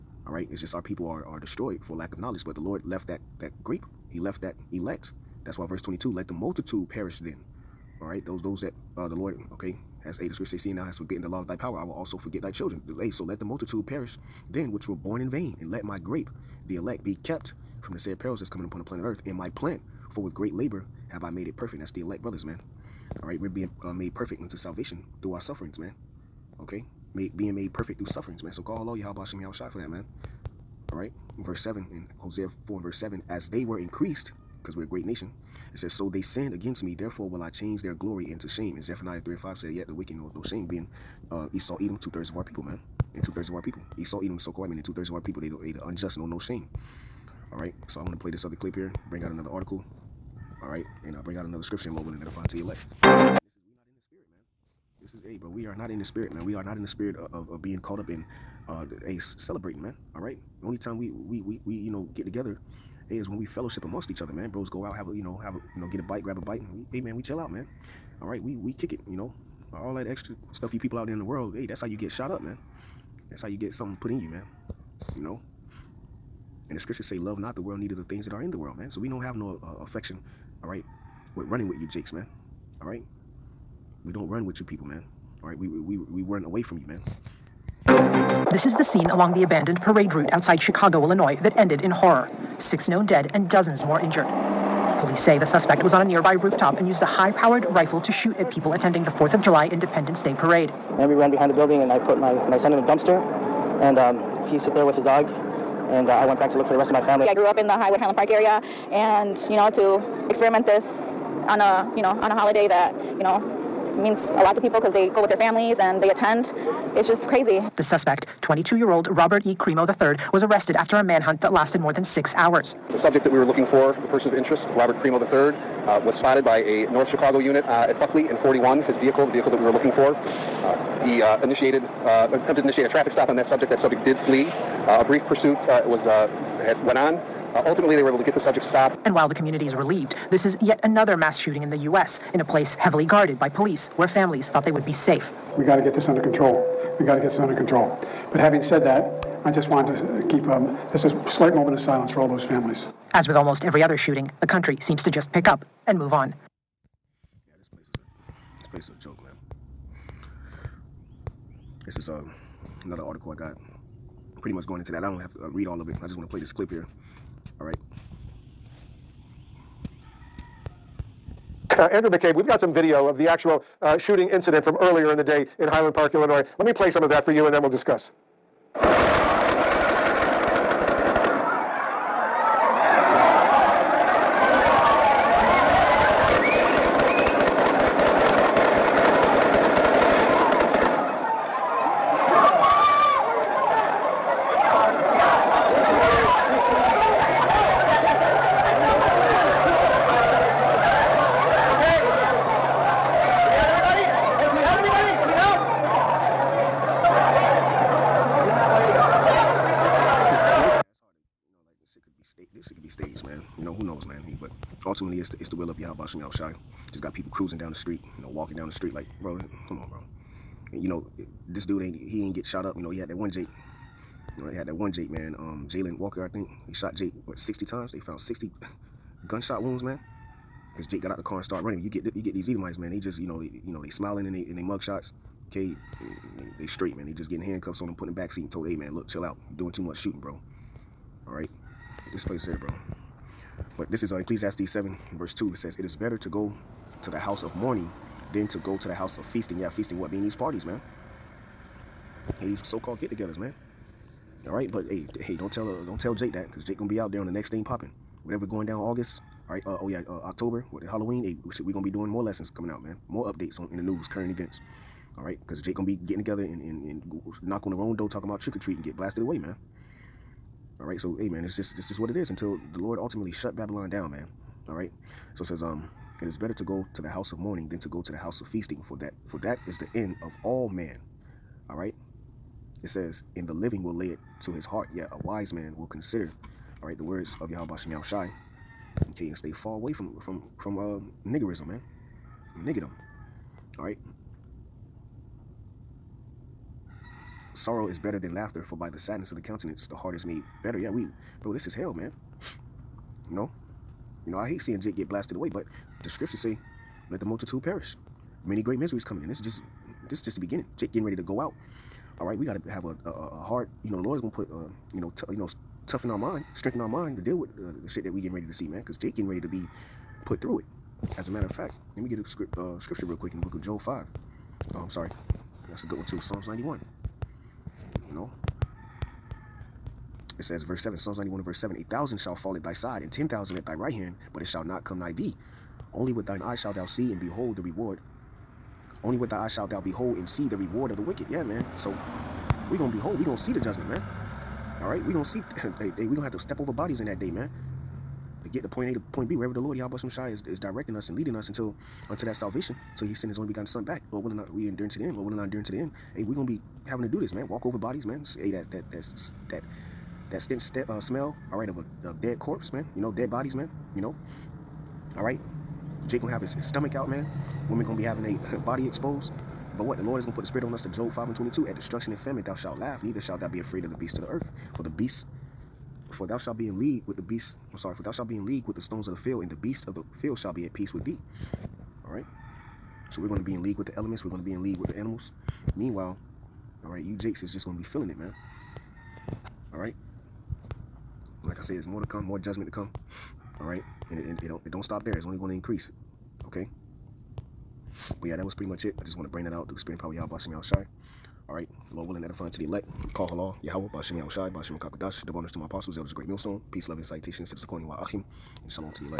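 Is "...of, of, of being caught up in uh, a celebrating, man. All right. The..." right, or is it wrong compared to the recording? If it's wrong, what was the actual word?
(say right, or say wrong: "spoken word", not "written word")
right.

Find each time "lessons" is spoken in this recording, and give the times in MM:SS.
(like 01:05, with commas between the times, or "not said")
04:22.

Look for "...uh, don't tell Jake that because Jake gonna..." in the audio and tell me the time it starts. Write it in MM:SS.
04:15.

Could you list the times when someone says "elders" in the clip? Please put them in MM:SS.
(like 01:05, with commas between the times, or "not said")
06:45.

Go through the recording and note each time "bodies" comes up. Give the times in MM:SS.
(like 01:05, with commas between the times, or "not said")
05:46, 05:57, 06:03.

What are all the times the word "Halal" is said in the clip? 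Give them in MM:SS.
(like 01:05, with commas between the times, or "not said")
06:43.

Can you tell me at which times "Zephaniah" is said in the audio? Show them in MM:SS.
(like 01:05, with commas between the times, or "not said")
00:38.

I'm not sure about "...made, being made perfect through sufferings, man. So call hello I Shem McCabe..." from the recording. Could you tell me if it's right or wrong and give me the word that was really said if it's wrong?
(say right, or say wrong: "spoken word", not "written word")
wrong: "Yahushai", not "McCabe".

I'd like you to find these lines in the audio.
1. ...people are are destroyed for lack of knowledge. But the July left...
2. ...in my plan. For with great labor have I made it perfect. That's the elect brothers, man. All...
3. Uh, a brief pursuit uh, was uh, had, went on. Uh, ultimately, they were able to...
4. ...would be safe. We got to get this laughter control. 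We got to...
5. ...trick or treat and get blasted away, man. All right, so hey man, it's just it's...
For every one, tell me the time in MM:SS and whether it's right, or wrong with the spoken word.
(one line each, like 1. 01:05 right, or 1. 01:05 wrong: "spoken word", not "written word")
1. 00:00 wrong: "Lord", not "July"
2. 00:19 right
3. 02:14 right
4. 02:24 wrong: "under", not "laughter"
5. 04:28 right.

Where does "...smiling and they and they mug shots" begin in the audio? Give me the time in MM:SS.
03:53.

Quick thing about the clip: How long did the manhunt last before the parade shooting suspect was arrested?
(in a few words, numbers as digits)
More than six hours.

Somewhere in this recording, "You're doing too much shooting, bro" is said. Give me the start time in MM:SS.
03:59.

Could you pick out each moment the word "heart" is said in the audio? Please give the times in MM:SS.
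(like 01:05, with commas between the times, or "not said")
04:44, 04:59.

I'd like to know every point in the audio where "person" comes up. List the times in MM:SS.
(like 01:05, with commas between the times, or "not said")
02:04.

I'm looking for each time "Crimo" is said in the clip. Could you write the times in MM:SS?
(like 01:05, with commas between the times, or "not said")
01:59, 02:04.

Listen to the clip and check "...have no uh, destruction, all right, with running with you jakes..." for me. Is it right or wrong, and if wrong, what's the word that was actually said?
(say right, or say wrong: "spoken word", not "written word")
wrong: "affection", not "destruction".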